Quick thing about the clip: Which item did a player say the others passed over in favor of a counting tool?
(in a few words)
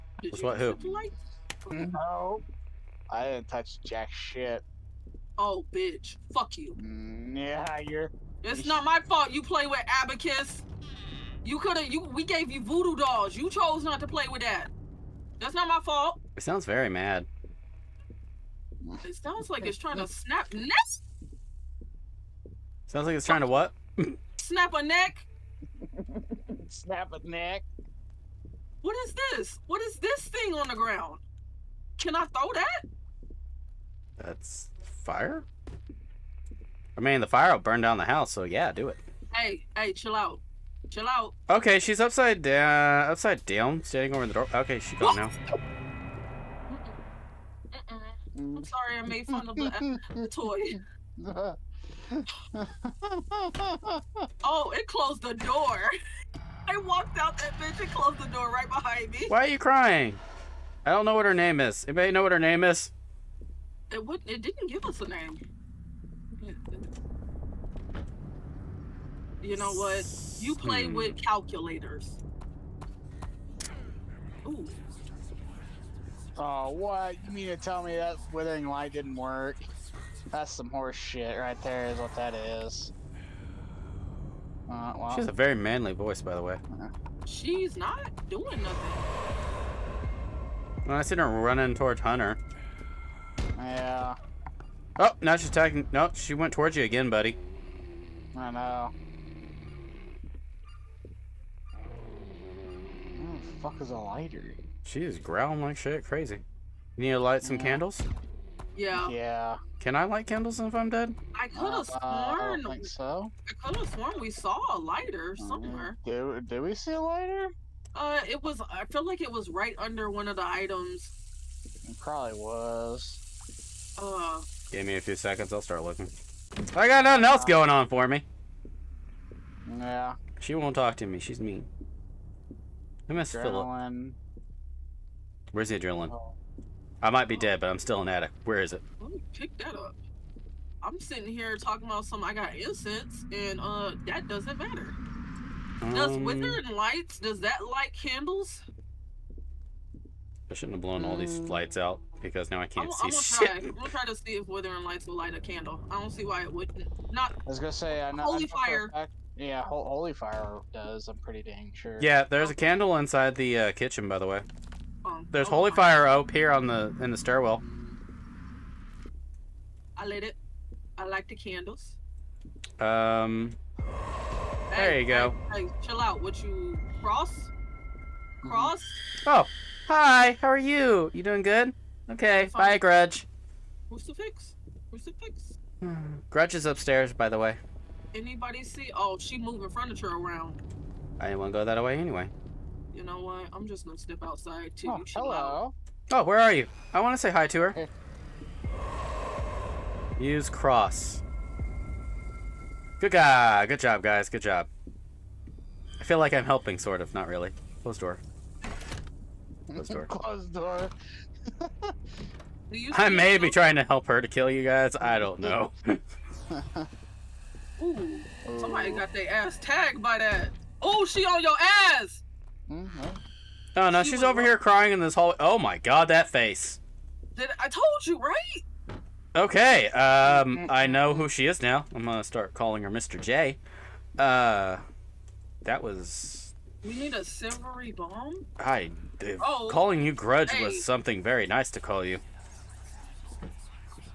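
voodoo dolls.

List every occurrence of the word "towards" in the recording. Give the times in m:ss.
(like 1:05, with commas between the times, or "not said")
1:31, 1:36.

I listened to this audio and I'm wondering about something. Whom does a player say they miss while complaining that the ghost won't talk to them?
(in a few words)
Philip.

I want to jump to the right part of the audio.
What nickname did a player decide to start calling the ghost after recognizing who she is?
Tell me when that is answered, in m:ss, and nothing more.
3:52.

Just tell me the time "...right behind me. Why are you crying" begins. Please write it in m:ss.
0:58.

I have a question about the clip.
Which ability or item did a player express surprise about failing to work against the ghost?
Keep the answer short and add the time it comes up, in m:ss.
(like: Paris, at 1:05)
withering light, at 1:18.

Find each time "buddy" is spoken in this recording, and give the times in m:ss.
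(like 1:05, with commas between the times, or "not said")
1:37.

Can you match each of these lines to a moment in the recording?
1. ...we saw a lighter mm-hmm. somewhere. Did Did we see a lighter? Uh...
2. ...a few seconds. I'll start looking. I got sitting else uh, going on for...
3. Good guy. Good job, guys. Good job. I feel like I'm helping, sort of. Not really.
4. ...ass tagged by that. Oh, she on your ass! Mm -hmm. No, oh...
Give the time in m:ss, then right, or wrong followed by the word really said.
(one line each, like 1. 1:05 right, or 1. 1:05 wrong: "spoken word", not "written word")
1. 1:54 right
2. 2:04 wrong: "nothing", not "sitting"
3. 3:23 right
4. 3:39 right.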